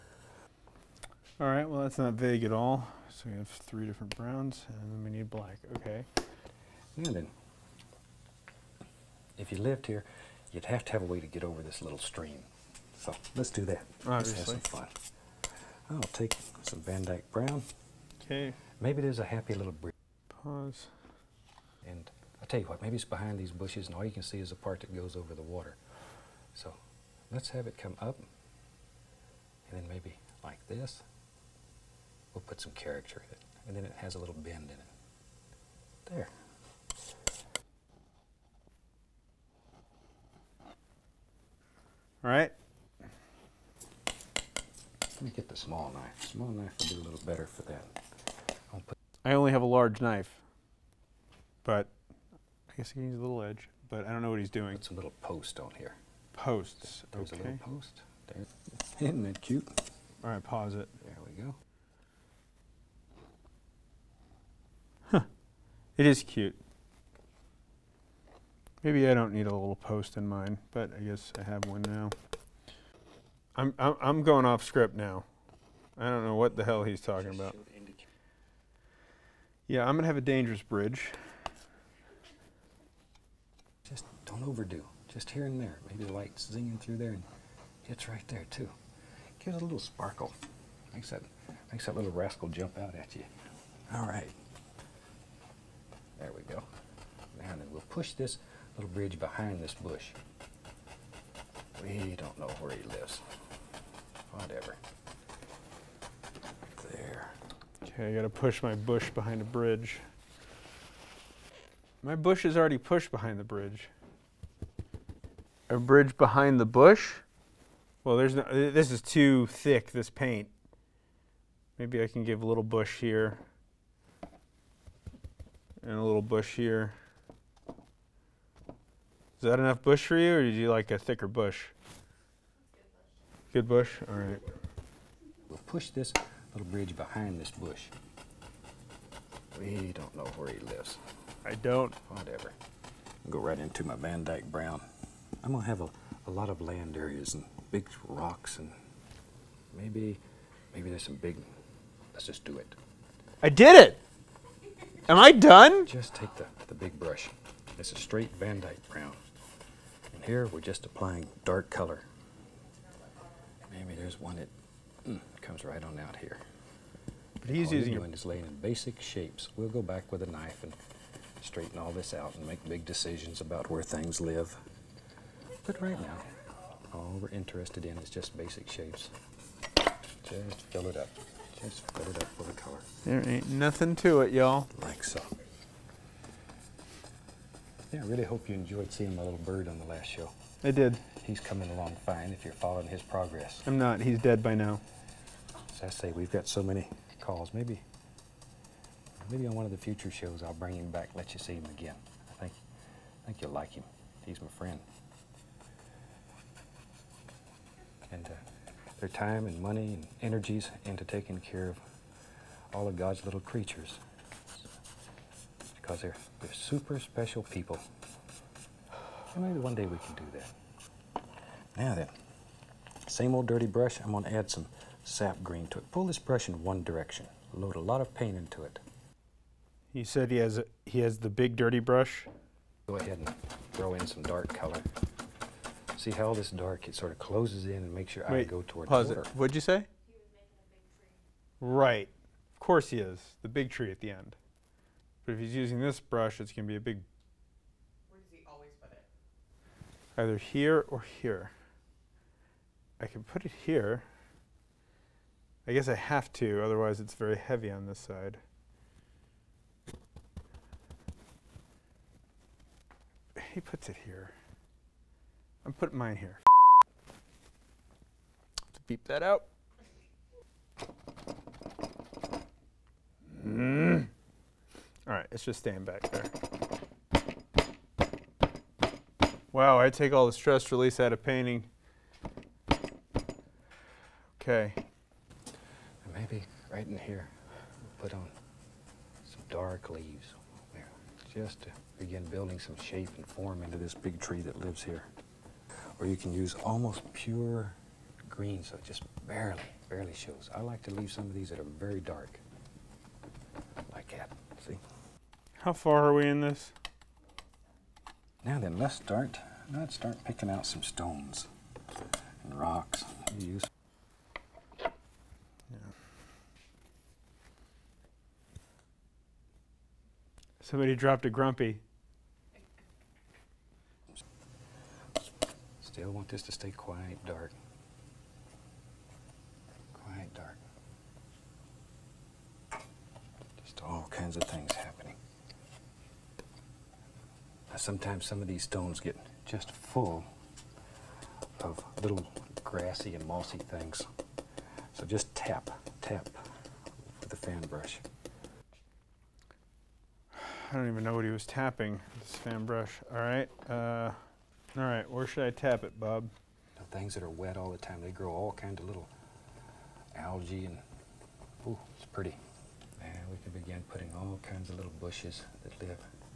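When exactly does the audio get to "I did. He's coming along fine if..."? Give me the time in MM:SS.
03:10.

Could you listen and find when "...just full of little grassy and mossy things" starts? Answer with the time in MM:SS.
05:39.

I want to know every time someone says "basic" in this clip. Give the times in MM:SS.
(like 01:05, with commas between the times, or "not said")
02:48, 02:58.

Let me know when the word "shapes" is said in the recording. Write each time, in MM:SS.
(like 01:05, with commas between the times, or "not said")
02:49, 02:58, 04:52.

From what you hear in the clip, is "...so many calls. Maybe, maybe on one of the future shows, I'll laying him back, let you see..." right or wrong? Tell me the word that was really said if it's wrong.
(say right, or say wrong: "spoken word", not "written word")
wrong: "bring", not "laying".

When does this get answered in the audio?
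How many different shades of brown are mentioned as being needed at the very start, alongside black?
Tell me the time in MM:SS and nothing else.
00:03.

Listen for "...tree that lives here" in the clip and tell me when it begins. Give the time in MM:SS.
04:54.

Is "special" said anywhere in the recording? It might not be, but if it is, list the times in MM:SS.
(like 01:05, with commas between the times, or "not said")
03:36.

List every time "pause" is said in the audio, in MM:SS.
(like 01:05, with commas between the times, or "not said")
00:20, 01:00, 03:58.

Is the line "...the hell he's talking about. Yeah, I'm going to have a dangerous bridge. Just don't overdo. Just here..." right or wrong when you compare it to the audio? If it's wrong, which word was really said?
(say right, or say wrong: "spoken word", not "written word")
right.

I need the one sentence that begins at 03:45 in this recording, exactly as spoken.
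Pull this brush in one direction.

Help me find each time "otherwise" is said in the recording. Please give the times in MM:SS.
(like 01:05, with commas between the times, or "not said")
04:16.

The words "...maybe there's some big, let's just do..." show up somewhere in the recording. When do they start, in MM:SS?
02:30.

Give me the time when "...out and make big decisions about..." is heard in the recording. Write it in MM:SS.
02:52.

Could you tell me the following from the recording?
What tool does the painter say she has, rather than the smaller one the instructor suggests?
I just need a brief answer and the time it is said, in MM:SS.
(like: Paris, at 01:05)
large knife, at 00:49.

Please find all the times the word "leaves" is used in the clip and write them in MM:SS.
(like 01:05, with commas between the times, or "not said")
04:49, 05:00.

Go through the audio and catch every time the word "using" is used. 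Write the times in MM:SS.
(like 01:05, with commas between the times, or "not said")
02:47, 04:05.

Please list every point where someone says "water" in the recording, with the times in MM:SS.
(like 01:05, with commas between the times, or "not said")
00:25, 03:59.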